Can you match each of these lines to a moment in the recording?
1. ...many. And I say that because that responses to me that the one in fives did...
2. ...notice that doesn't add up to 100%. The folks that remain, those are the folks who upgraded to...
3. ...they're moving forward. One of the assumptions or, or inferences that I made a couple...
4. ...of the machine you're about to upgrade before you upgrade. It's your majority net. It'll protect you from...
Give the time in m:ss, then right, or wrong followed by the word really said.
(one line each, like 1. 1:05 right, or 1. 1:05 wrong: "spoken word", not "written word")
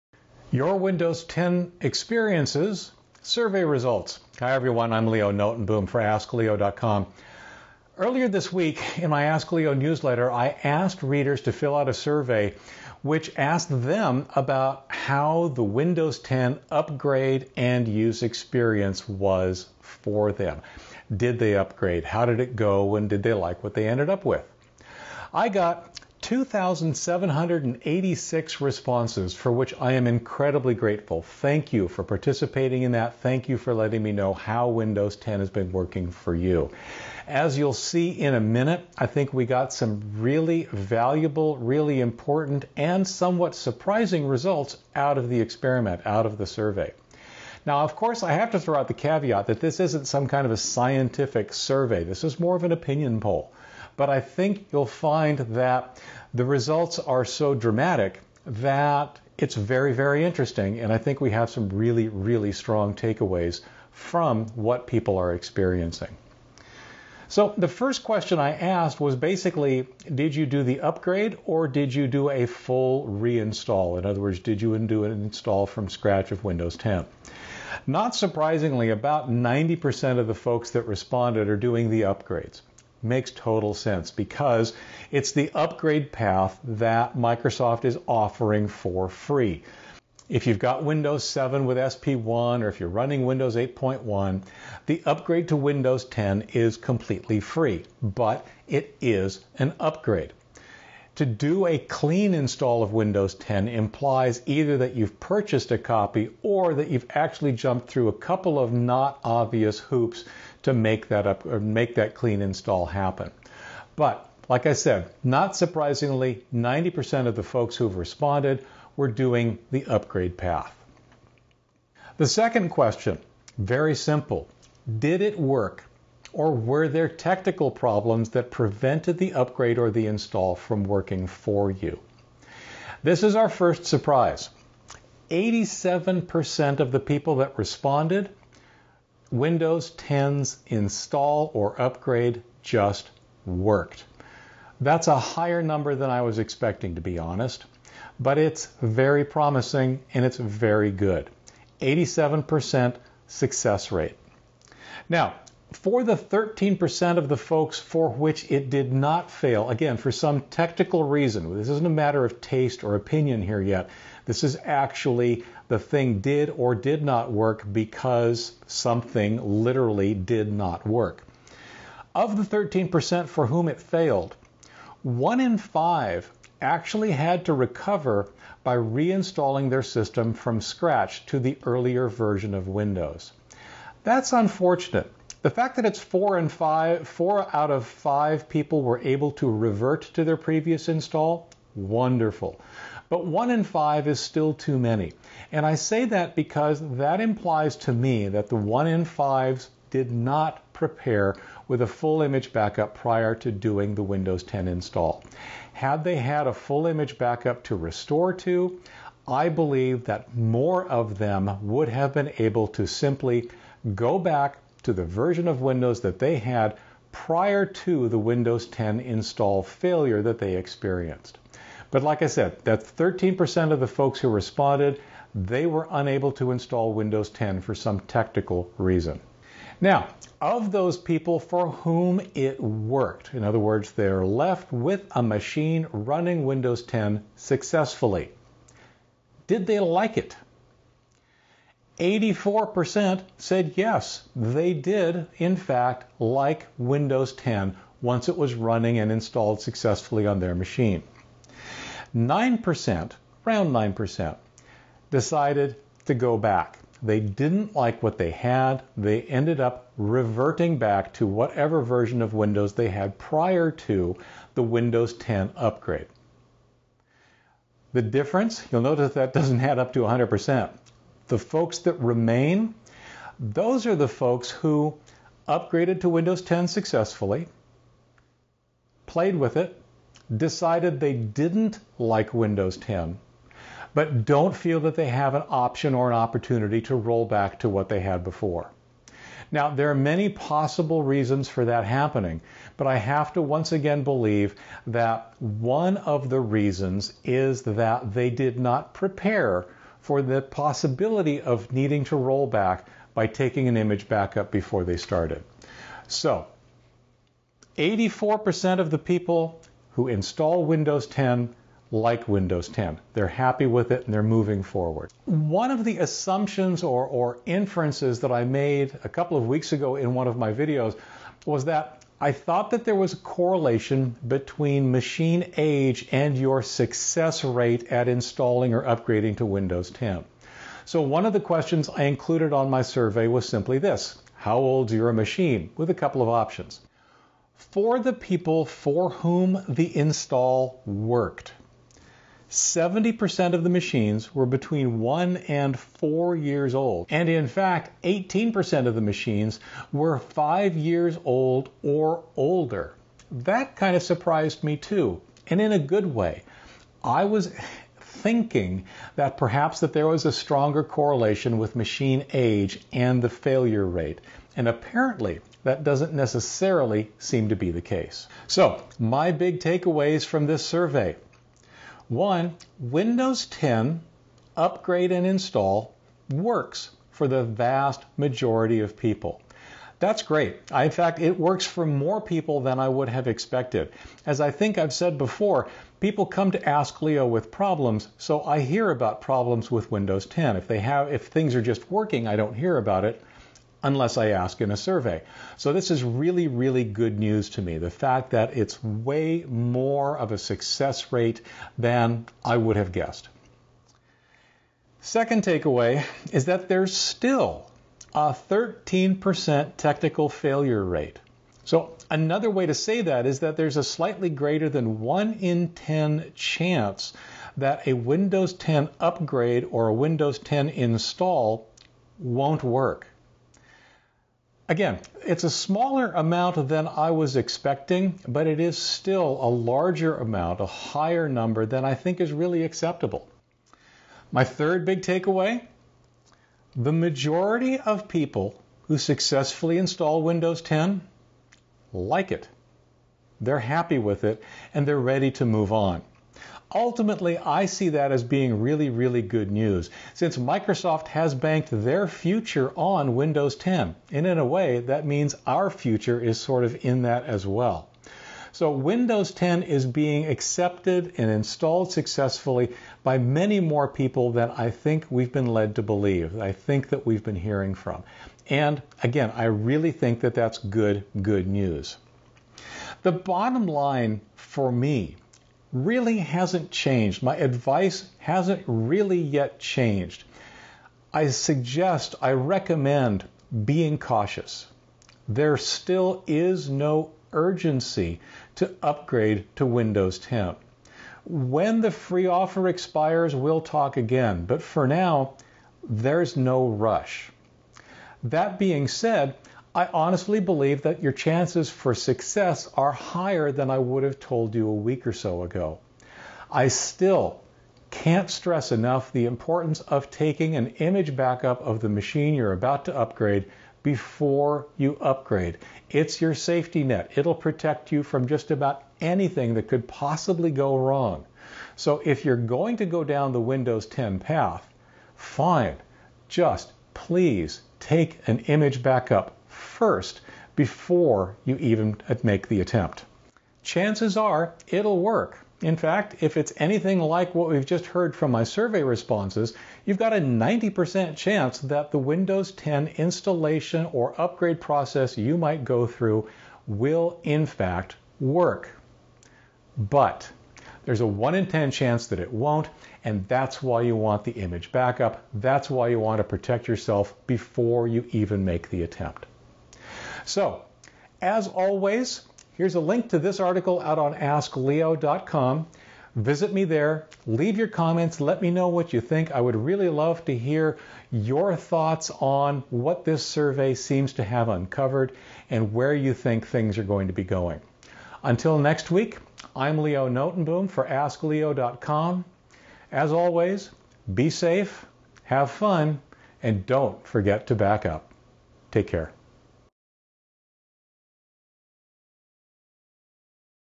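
1. 3:14 wrong: "implies", not "responses"
2. 4:28 right
3. 5:14 right
4. 8:31 wrong: "safety", not "majority".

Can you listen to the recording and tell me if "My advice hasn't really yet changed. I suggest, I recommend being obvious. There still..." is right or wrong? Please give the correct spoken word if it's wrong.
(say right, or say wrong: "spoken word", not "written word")
wrong: "cautious", not "obvious".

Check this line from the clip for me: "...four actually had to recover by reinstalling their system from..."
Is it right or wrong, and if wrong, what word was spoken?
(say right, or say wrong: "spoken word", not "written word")
wrong: "five", not "four".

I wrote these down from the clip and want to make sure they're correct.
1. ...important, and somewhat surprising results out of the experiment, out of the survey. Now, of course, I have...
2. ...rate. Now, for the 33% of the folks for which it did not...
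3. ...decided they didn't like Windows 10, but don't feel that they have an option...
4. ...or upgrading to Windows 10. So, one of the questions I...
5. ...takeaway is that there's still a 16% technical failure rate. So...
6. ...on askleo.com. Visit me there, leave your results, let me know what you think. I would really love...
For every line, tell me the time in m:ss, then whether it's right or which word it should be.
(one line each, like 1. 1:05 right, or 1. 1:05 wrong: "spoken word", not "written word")
1. 0:42 right
2. 2:33 wrong: "13", not "33"
3. 4:40 right
4. 5:28 right
5. 6:45 wrong: "13", not "16"
6. 9:23 wrong: "comments", not "results".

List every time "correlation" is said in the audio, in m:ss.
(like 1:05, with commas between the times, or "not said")
5:23, 6:00.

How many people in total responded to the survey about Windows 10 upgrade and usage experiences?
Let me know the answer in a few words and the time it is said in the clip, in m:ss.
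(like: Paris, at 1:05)
2,786, at 0:26.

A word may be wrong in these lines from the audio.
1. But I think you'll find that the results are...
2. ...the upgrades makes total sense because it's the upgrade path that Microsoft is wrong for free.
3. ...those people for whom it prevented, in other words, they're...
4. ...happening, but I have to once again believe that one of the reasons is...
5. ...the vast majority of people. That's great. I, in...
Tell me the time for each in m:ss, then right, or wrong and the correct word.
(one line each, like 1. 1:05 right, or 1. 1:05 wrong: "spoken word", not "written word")
1. 0:54 right
2. 1:21 wrong: "offering", not "wrong"
3. 3:50 wrong: "worked", not "prevented"
4. 4:51 right
5. 6:17 right.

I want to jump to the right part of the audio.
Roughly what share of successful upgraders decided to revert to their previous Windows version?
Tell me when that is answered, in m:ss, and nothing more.
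4:13.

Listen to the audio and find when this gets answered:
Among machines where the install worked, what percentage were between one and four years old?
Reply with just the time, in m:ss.
5:42.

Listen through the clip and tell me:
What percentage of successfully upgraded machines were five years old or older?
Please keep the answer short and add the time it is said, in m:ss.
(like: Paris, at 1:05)
18%, at 5:48.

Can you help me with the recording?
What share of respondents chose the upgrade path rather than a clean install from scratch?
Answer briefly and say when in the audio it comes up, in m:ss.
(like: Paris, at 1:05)
90%, at 1:18.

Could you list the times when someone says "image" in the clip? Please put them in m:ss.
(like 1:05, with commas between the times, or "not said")
3:22, 3:26, 5:03, 8:30, 8:48, 9:14.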